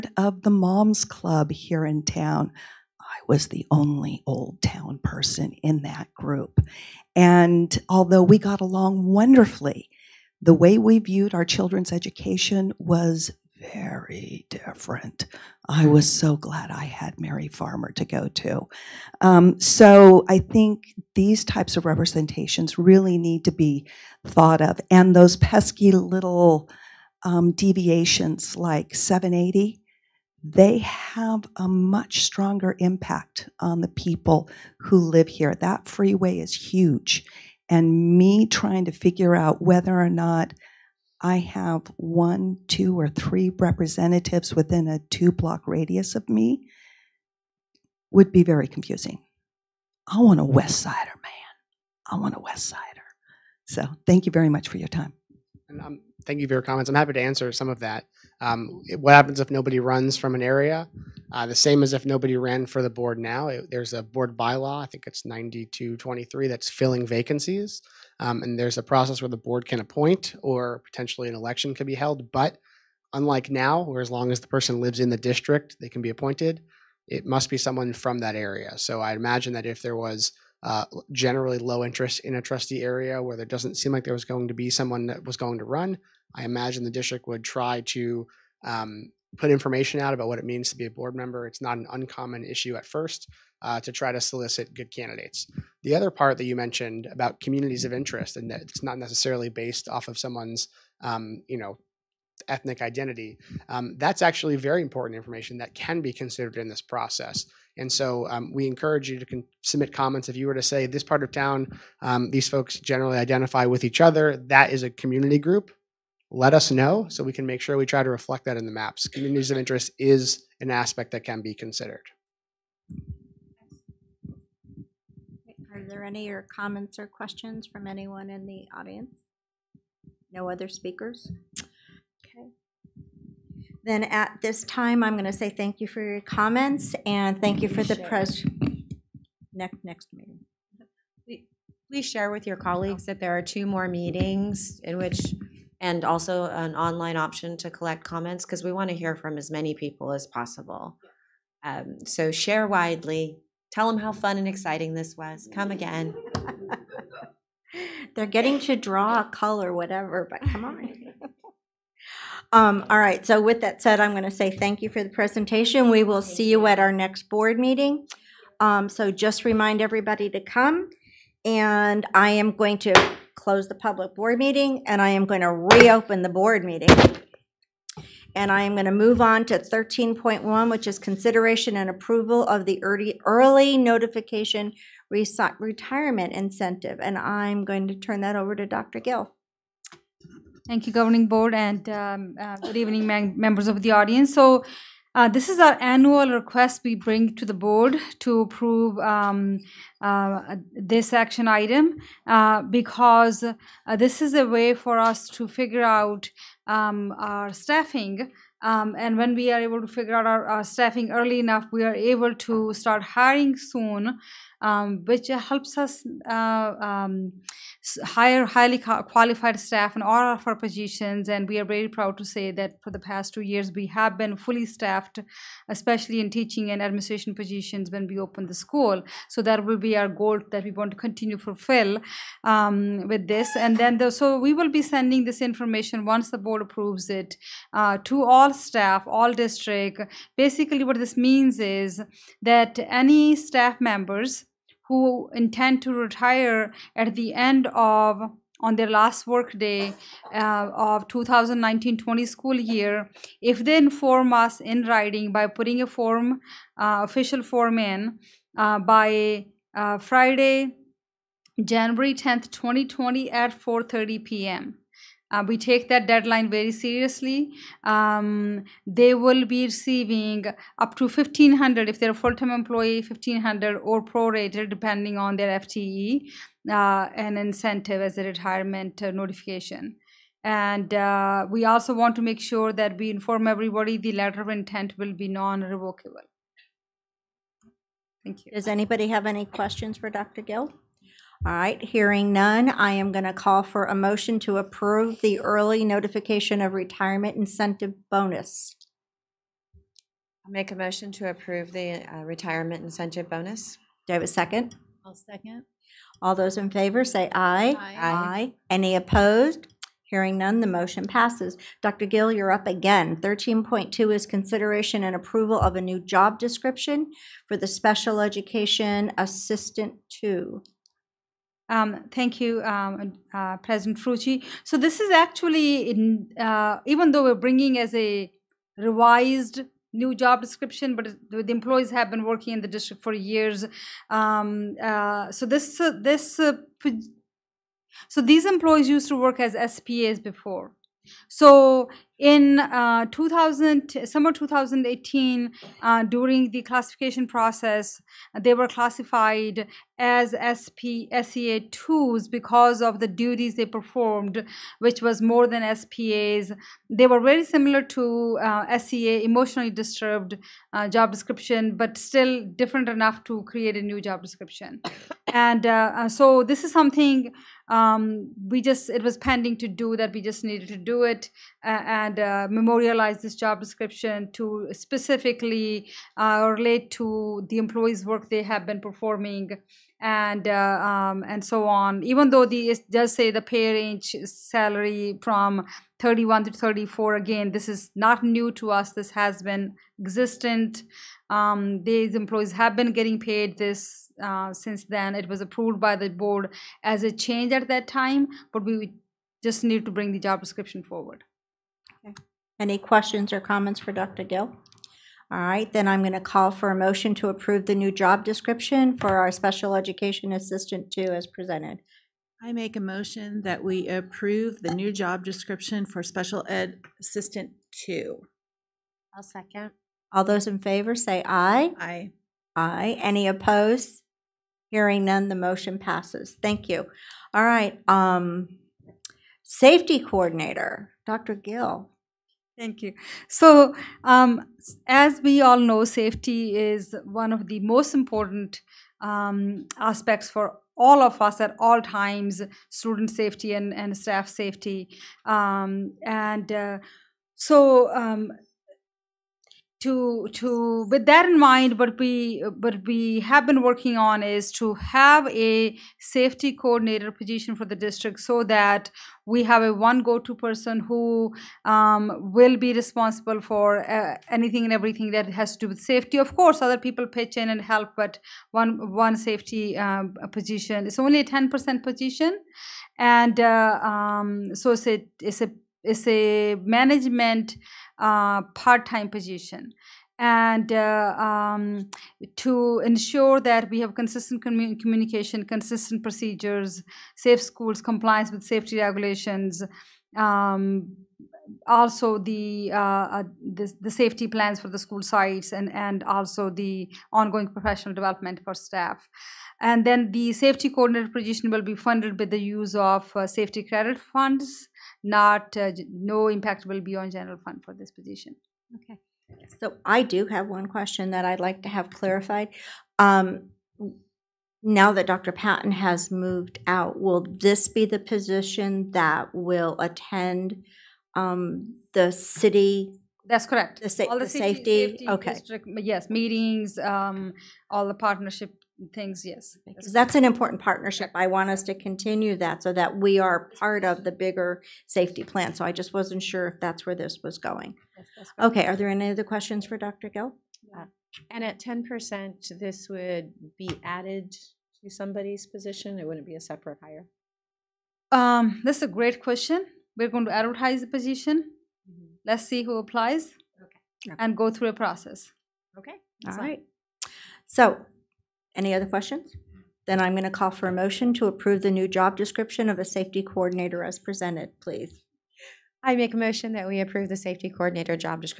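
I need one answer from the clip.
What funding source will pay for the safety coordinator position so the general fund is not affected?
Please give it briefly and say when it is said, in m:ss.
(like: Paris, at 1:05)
safety credit funds, at 8:23.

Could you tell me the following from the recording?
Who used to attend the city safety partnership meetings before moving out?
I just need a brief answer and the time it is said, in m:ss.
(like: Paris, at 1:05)
Dr. Patton, at 8:35.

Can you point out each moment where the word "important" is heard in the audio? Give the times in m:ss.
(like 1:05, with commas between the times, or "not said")
1:44, 7:17, 8:50.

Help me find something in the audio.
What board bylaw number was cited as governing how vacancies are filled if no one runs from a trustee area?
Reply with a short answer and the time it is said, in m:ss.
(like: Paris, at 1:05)
9223, at 1:05.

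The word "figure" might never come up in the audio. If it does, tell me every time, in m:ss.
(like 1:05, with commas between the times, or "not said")
0:38, 3:25, 3:29.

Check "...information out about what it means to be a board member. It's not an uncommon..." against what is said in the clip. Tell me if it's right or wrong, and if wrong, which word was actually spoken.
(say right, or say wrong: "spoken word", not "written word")
right.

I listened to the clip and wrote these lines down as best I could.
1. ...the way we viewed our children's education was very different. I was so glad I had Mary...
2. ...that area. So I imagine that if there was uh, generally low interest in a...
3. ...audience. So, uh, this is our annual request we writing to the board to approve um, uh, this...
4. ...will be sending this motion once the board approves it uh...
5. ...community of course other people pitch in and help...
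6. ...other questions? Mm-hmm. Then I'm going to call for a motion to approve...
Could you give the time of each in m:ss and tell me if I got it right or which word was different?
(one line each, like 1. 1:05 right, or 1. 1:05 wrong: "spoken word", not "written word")
1. 0:10 right
2. 1:18 right
3. 3:13 wrong: "bring", not "writing"
4. 3:54 wrong: "information", not "motion"
5. 7:45 wrong: "safety", not "community"
6. 9:18 right.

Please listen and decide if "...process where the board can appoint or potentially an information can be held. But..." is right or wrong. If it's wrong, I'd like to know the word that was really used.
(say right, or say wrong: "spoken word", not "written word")
wrong: "election", not "information".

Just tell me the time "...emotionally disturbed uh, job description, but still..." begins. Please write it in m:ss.
5:59.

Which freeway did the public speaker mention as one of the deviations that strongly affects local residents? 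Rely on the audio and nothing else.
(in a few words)
780.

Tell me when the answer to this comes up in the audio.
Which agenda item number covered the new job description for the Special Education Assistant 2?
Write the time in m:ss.
5:13.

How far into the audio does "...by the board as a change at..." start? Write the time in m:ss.
6:35.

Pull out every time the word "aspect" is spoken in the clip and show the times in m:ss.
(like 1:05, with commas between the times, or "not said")
2:00, 7:19.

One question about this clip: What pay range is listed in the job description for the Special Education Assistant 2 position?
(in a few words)
31 to 34.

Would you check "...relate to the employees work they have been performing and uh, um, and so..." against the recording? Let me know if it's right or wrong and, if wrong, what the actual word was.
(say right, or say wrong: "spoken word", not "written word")
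right.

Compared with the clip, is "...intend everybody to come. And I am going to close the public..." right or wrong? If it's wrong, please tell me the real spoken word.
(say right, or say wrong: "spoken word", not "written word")
wrong: "remind", not "intend".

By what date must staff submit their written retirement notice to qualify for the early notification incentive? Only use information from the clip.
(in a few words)
Friday January 10th 2020.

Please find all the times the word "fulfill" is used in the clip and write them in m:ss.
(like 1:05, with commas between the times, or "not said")
3:51.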